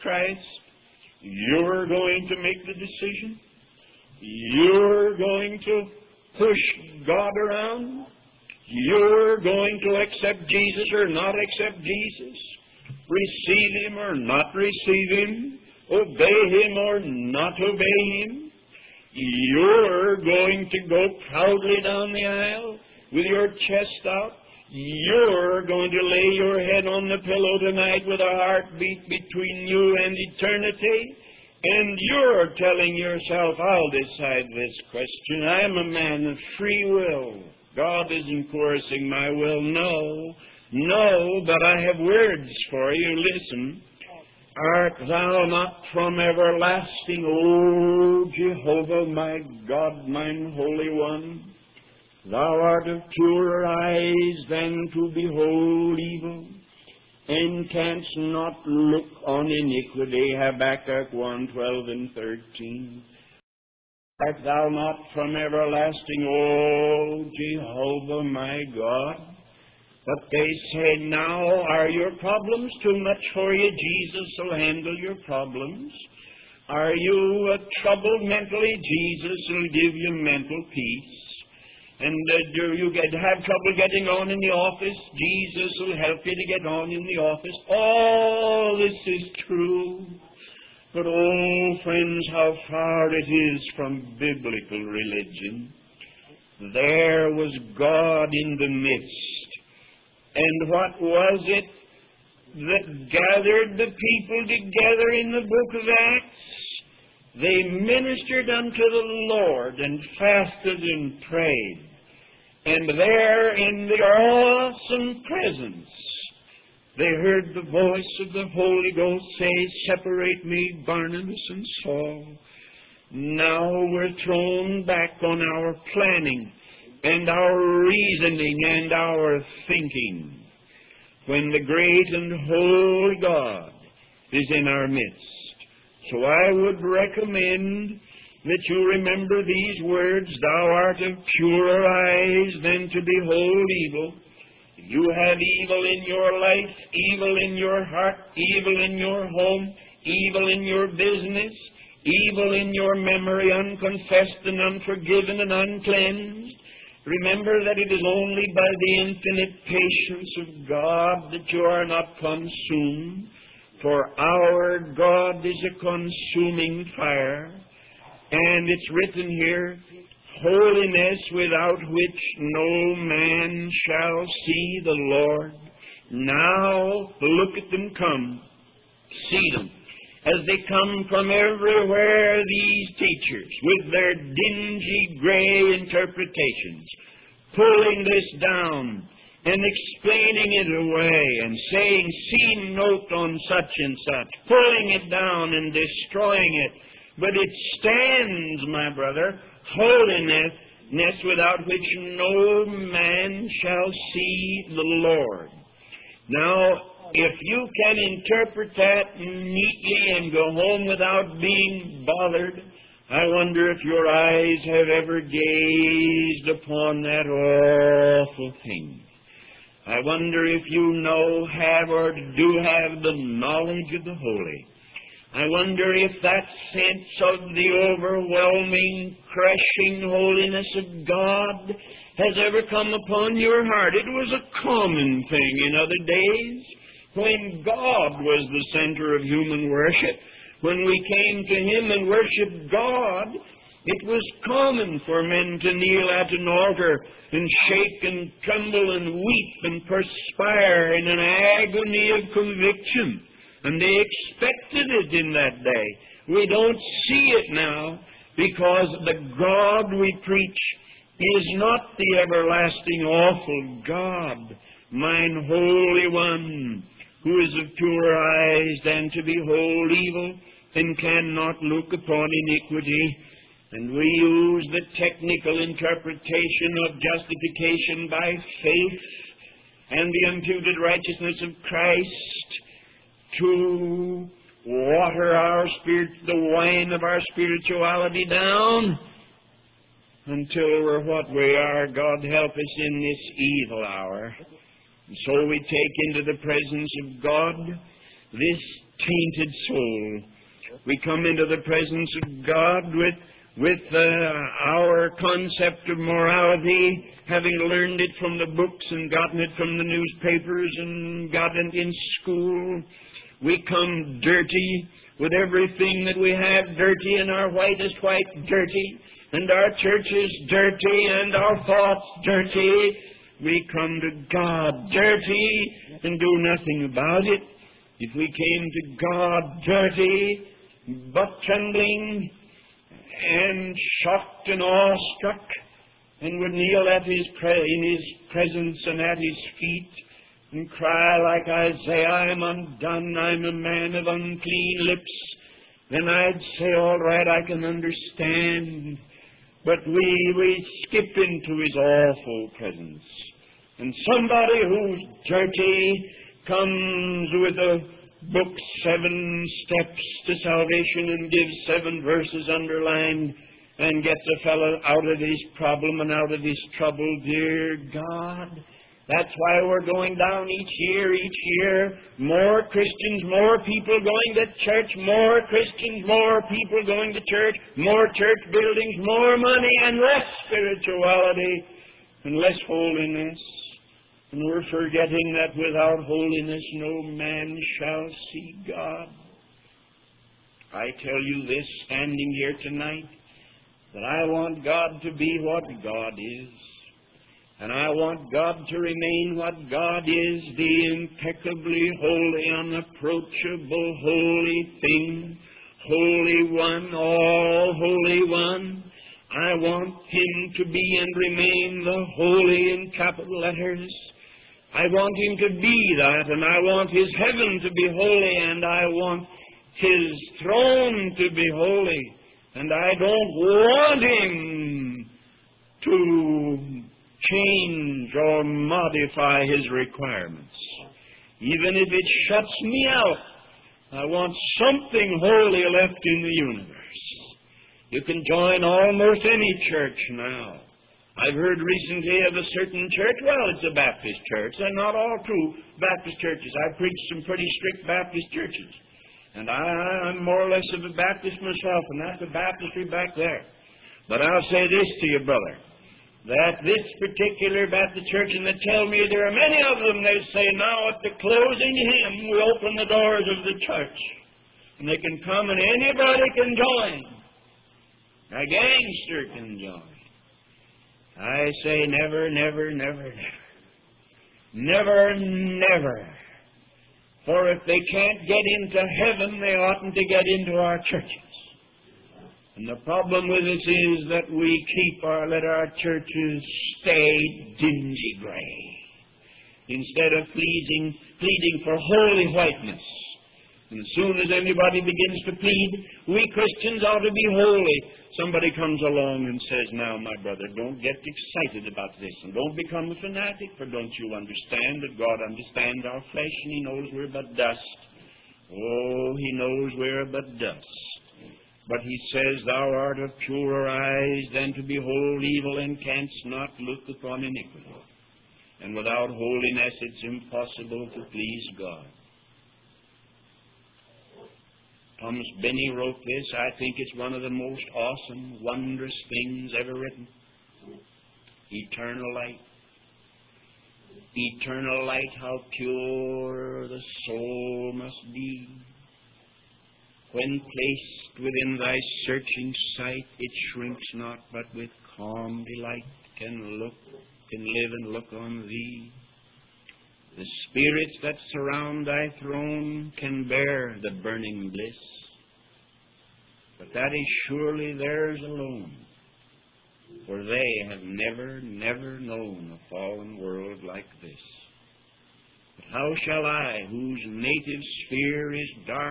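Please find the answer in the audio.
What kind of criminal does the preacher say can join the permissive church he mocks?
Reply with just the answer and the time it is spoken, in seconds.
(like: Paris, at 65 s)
A gangster, at 468 s.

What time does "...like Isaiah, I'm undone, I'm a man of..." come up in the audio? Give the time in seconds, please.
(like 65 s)
341 s.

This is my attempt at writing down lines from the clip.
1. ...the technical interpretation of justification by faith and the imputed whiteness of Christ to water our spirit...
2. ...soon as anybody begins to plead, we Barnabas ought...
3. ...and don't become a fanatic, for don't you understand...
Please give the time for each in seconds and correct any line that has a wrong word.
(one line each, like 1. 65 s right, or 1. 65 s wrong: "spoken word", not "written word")
1. 274 s wrong: "righteousness", not "whiteness"
2. 493 s wrong: "Christians", not "Barnabas"
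3. 502 s right.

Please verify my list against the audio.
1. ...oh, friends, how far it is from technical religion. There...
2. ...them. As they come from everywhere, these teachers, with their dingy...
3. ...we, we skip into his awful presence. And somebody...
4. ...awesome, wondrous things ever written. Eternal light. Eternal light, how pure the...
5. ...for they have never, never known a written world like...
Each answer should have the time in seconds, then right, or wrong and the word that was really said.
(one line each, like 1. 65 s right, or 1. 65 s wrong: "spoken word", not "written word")
1. 91 s wrong: "biblical", not "technical"
2. 179 s right
3. 349 s right
4. 527 s right
5. 560 s wrong: "fallen", not "written".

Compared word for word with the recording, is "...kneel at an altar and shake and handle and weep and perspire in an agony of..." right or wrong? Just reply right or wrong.
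wrong.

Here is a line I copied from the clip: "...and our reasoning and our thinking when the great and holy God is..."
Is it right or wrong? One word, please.
right.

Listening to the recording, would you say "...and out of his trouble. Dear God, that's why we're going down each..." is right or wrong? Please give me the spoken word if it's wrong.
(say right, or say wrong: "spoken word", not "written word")
right.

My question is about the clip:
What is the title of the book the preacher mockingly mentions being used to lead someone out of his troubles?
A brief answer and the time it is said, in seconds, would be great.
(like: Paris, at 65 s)
Seven Steps to Salvation, at 358 s.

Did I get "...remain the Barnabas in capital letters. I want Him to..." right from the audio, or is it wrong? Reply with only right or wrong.
wrong.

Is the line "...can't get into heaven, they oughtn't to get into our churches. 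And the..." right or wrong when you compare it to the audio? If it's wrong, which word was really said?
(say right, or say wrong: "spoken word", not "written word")
right.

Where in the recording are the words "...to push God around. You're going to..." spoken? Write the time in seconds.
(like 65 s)
5 s.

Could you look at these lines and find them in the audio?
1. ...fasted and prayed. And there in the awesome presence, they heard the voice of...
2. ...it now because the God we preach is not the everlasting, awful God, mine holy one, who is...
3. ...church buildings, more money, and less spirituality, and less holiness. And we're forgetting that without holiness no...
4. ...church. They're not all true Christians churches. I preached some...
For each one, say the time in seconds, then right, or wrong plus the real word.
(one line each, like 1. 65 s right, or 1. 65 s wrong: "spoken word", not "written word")
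1. 110 s right
2. 257 s right
3. 378 s right
4. 444 s wrong: "Baptist", not "Christians".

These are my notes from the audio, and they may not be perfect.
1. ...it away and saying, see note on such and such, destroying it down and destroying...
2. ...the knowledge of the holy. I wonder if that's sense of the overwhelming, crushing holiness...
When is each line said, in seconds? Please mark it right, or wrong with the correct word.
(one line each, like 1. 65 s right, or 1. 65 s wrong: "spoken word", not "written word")
1. 190 s wrong: "pulling", not "destroying"
2. 223 s right.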